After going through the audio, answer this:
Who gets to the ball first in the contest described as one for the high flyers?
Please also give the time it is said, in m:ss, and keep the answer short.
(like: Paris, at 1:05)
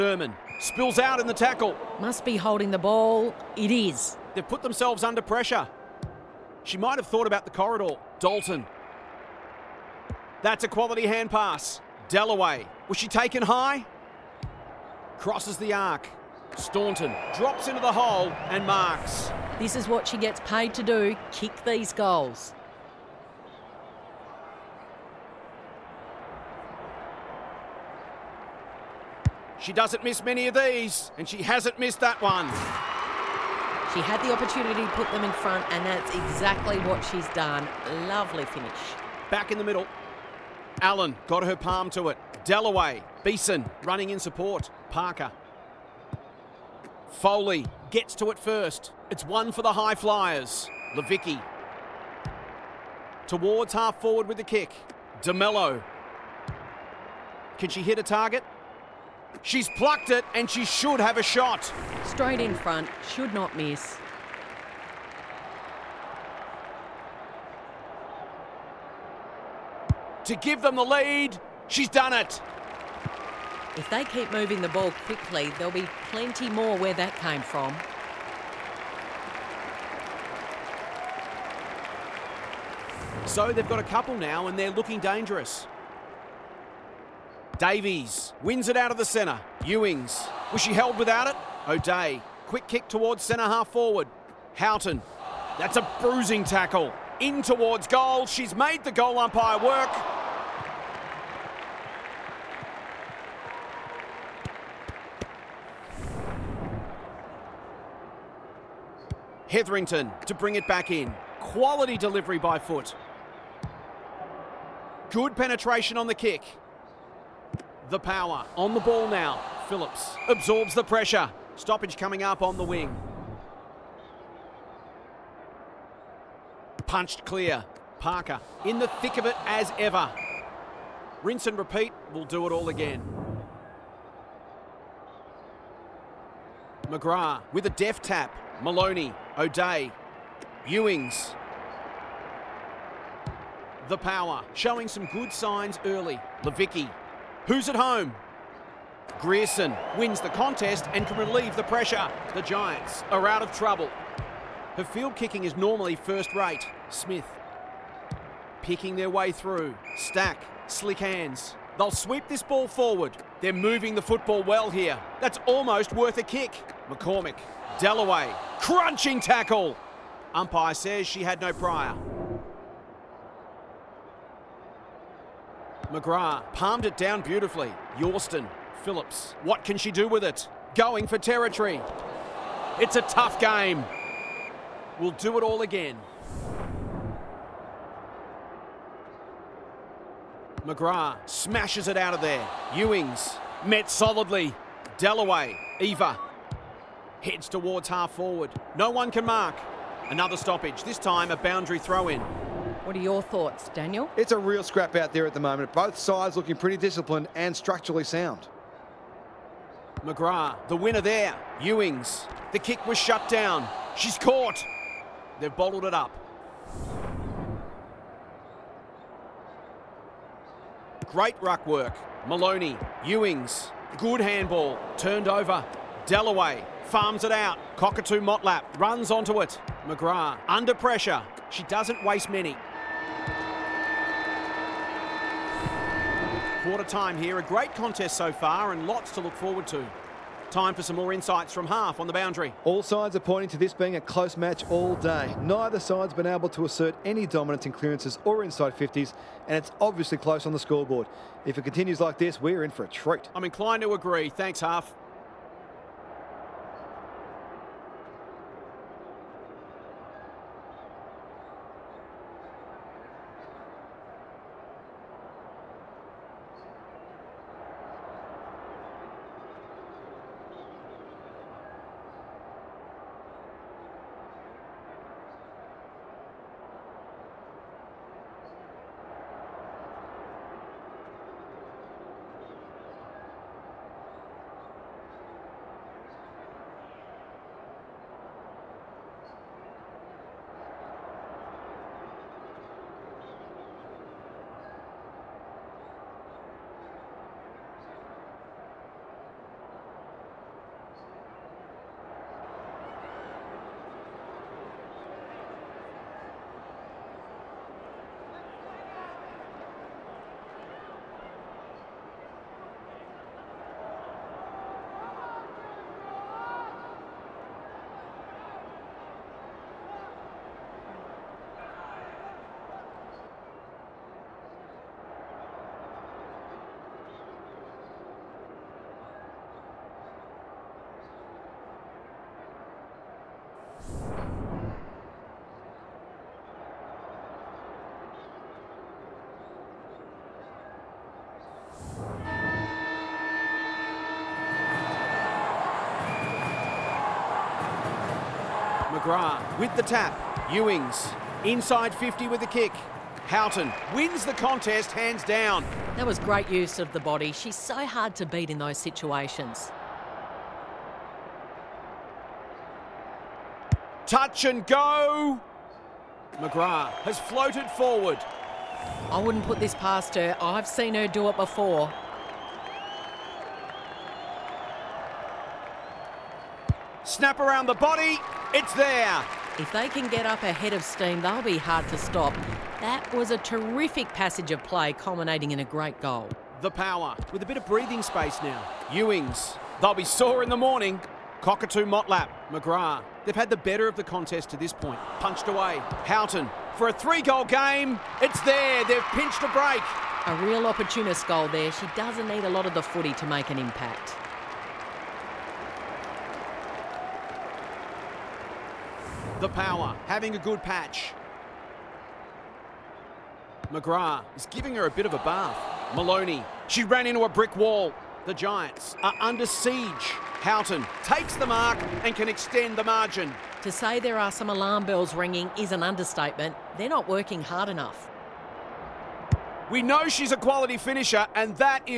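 Foley, at 0:47.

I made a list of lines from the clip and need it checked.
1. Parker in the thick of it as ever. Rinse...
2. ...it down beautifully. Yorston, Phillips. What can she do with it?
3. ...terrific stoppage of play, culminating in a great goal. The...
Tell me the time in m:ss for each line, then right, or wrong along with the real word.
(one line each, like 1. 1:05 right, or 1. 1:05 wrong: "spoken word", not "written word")
1. 2:07 right
2. 2:56 right
3. 6:23 wrong: "passage", not "stoppage".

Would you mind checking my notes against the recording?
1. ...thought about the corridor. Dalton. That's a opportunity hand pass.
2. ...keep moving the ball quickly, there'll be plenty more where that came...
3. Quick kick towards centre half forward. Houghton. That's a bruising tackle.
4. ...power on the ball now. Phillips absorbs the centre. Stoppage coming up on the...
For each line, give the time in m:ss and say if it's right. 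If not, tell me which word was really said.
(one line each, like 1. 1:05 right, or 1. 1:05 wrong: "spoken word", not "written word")
1. 0:07 wrong: "quality", not "opportunity"
2. 1:14 right
3. 1:32 right
4. 1:57 wrong: "pressure", not "centre".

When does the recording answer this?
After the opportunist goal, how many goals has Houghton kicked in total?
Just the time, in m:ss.
6:36.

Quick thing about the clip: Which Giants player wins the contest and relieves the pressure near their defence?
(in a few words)
Grierson.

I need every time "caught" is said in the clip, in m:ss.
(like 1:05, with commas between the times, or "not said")
3:34.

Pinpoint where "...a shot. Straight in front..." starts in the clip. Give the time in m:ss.
1:01.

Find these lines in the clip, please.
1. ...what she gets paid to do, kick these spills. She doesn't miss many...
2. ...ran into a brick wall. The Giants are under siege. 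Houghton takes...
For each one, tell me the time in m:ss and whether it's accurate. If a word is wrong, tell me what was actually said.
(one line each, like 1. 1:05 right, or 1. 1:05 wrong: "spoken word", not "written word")
1. 0:19 wrong: "goals", not "spills"
2. 6:56 right.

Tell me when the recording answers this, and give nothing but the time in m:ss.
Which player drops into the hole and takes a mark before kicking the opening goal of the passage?
0:16.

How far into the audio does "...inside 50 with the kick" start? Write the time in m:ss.
5:51.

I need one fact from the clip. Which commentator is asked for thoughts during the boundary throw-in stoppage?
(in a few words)
Daniel.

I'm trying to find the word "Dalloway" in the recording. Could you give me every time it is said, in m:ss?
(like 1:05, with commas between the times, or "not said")
0:42, 3:46.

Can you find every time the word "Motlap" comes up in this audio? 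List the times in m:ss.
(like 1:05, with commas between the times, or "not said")
3:48, 6:31.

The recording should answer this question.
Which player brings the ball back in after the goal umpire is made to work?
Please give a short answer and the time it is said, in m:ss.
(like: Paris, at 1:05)
Hetherington, at 1:49.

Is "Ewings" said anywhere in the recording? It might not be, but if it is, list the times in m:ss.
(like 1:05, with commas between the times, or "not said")
1:29, 2:20, 3:12, 3:31, 3:43, 5:50, 6:28.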